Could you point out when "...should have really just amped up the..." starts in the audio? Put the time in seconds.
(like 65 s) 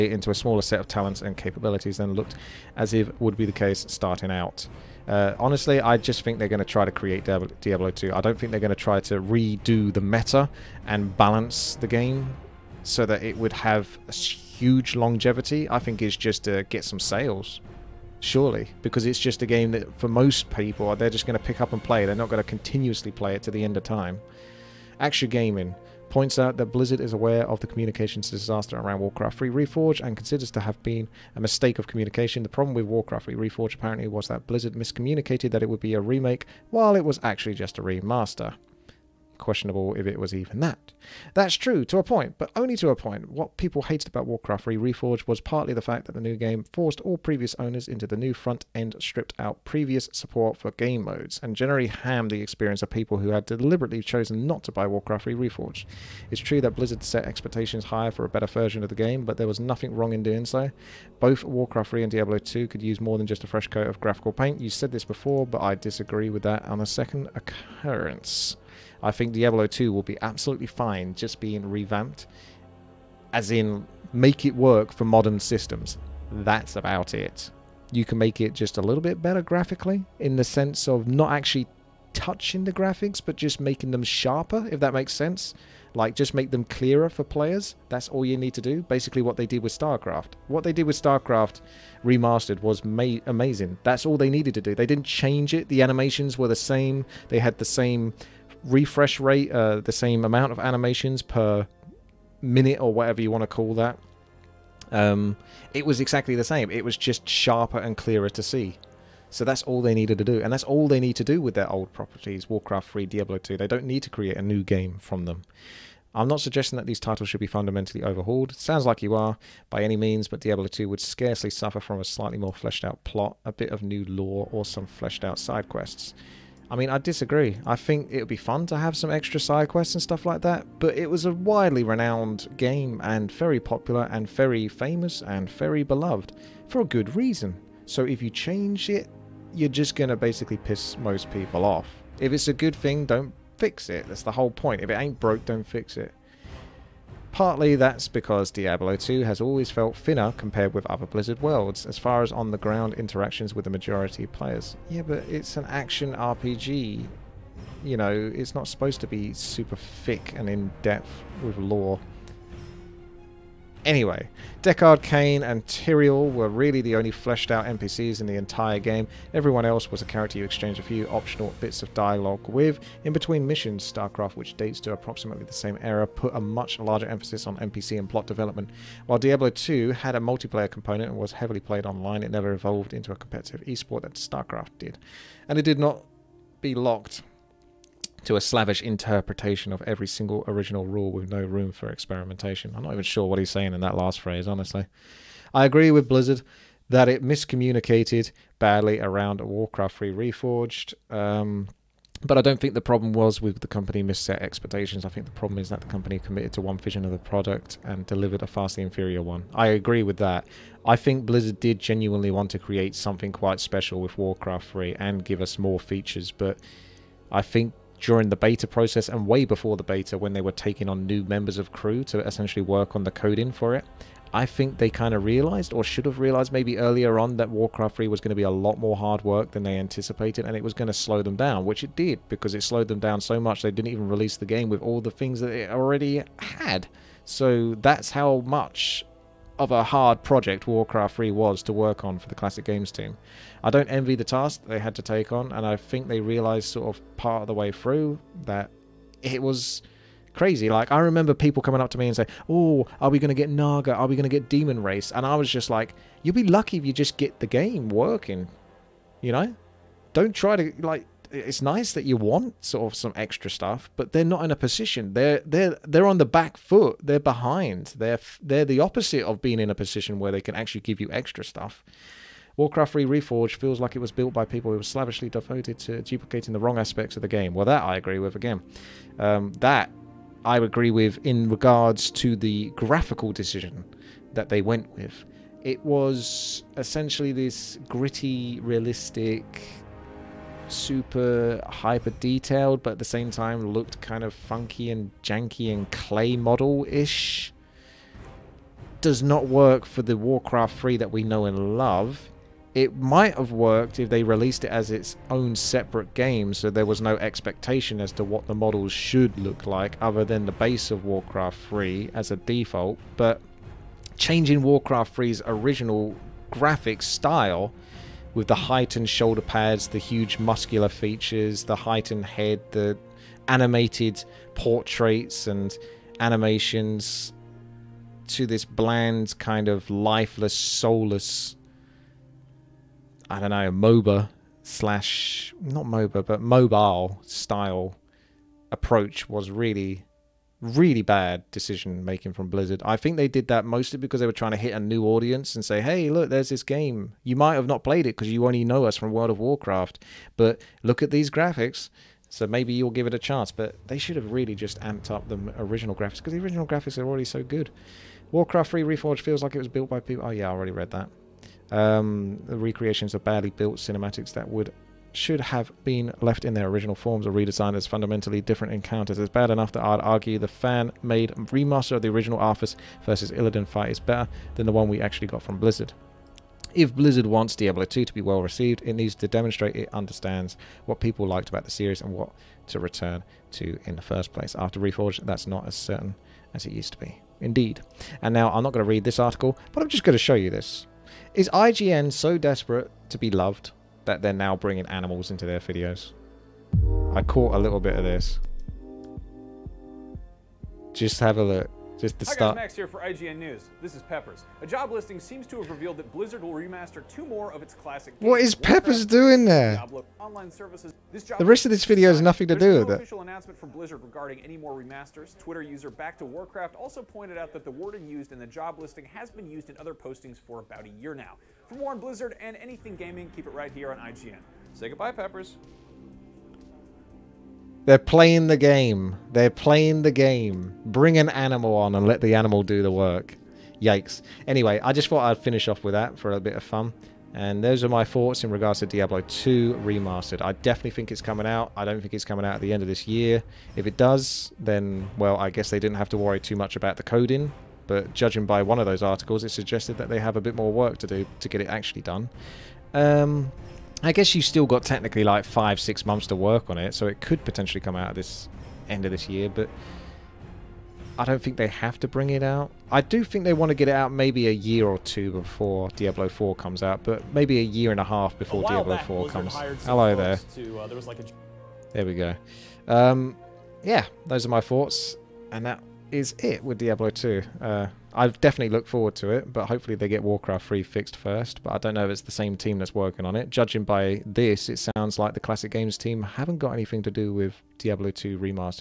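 353 s.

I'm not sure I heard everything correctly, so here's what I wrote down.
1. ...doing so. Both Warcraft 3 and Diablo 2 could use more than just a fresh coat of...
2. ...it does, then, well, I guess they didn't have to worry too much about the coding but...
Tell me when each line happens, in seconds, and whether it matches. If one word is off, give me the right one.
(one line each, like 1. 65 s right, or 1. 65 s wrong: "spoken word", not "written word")
1. 60 s right
2. 443 s right.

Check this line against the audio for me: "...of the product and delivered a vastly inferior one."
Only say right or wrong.
right.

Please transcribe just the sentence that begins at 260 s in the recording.
Don't try to, like, it's nice that you want sort of some extra stuff, but they're not in a position.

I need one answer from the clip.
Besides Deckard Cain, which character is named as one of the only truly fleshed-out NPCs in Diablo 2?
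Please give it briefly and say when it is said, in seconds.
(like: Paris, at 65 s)
Tyrael, at 165 s.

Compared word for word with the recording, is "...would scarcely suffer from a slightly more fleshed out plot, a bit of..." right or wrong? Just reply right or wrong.
right.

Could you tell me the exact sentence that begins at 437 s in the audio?
And those are my thoughts in regards to Diablo 2 Remastered.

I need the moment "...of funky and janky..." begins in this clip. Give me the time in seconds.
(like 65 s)
294 s.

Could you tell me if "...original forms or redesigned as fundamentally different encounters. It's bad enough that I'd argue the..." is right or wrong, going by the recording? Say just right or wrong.
right.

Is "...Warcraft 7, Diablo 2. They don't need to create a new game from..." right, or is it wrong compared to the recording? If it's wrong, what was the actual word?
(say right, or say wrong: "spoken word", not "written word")
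wrong: "3", not "7".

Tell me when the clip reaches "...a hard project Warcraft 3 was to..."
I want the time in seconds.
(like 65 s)
239 s.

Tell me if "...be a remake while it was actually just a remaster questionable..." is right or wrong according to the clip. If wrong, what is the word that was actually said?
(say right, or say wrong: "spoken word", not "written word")
right.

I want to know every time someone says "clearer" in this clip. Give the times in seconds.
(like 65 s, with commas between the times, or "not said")
86 s, 107 s.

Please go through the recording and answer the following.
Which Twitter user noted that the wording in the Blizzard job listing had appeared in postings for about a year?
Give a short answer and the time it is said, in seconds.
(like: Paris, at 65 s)
Back to Warcraft, at 415 s.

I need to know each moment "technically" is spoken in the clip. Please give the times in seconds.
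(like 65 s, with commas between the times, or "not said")
454 s.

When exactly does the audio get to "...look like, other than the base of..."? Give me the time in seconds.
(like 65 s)
309 s.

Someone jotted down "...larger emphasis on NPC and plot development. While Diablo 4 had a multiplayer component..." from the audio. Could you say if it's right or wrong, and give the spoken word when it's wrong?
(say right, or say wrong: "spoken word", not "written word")
wrong: "2", not "4".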